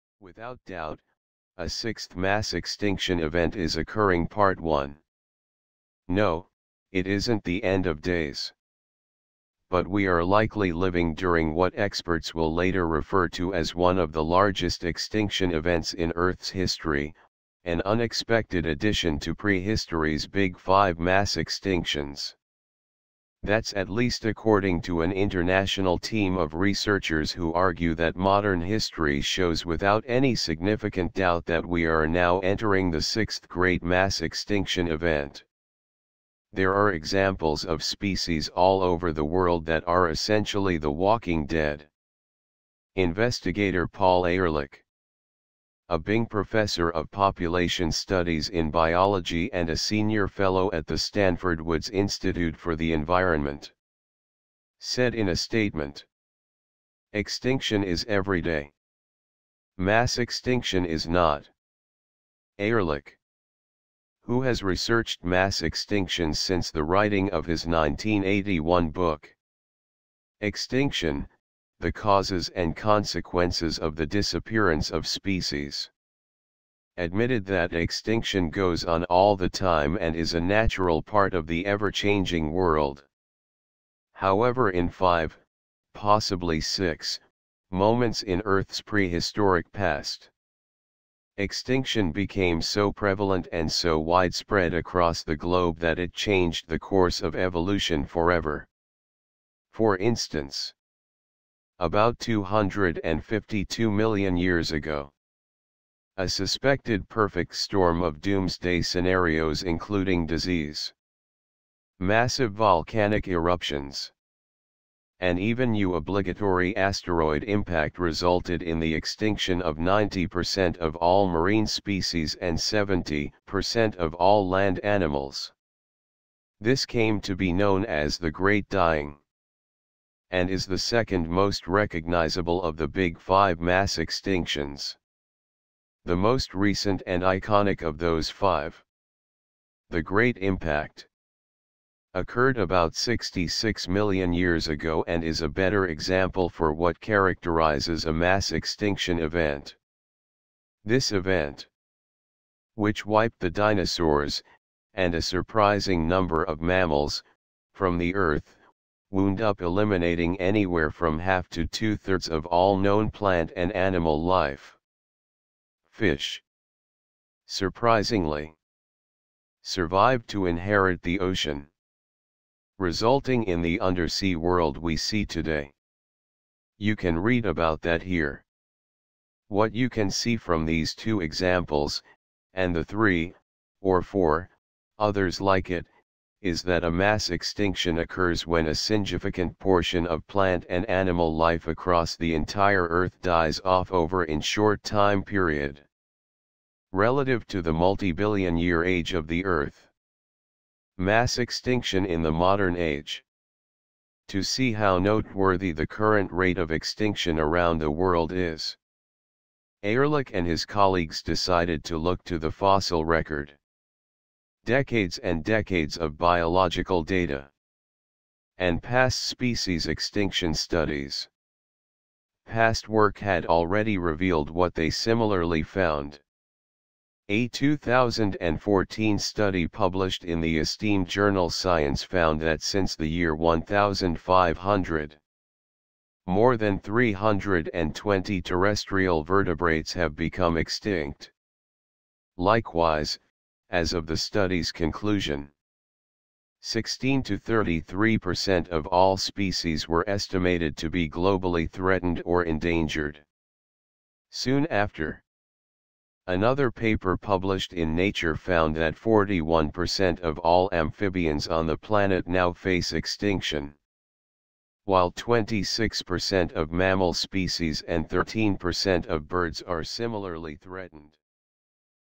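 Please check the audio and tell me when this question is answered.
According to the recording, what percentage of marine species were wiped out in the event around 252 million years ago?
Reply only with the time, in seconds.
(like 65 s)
119 s.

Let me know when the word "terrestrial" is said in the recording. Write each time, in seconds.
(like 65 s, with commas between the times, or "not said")
238 s.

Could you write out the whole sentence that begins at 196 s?
Relative to the multi-billion year age of the Earth.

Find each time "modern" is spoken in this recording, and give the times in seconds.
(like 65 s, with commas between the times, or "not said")
28 s, 202 s.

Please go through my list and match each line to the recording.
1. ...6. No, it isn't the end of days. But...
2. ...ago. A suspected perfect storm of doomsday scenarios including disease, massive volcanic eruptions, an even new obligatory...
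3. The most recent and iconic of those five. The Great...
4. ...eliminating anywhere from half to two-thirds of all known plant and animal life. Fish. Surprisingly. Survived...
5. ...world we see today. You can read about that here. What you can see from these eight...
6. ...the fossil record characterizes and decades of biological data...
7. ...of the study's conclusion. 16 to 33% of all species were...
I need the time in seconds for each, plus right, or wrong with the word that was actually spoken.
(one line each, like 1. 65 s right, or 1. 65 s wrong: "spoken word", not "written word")
1. 4 s wrong: "1", not "6"
2. 104 s right
3. 136 s right
4. 159 s right
5. 174 s wrong: "two", not "eight"
6. 212 s wrong: "decades", not "characterizes"
7. 243 s right.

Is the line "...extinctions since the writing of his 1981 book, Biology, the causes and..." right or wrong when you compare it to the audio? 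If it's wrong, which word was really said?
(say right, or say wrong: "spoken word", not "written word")
wrong: "Extinction", not "Biology".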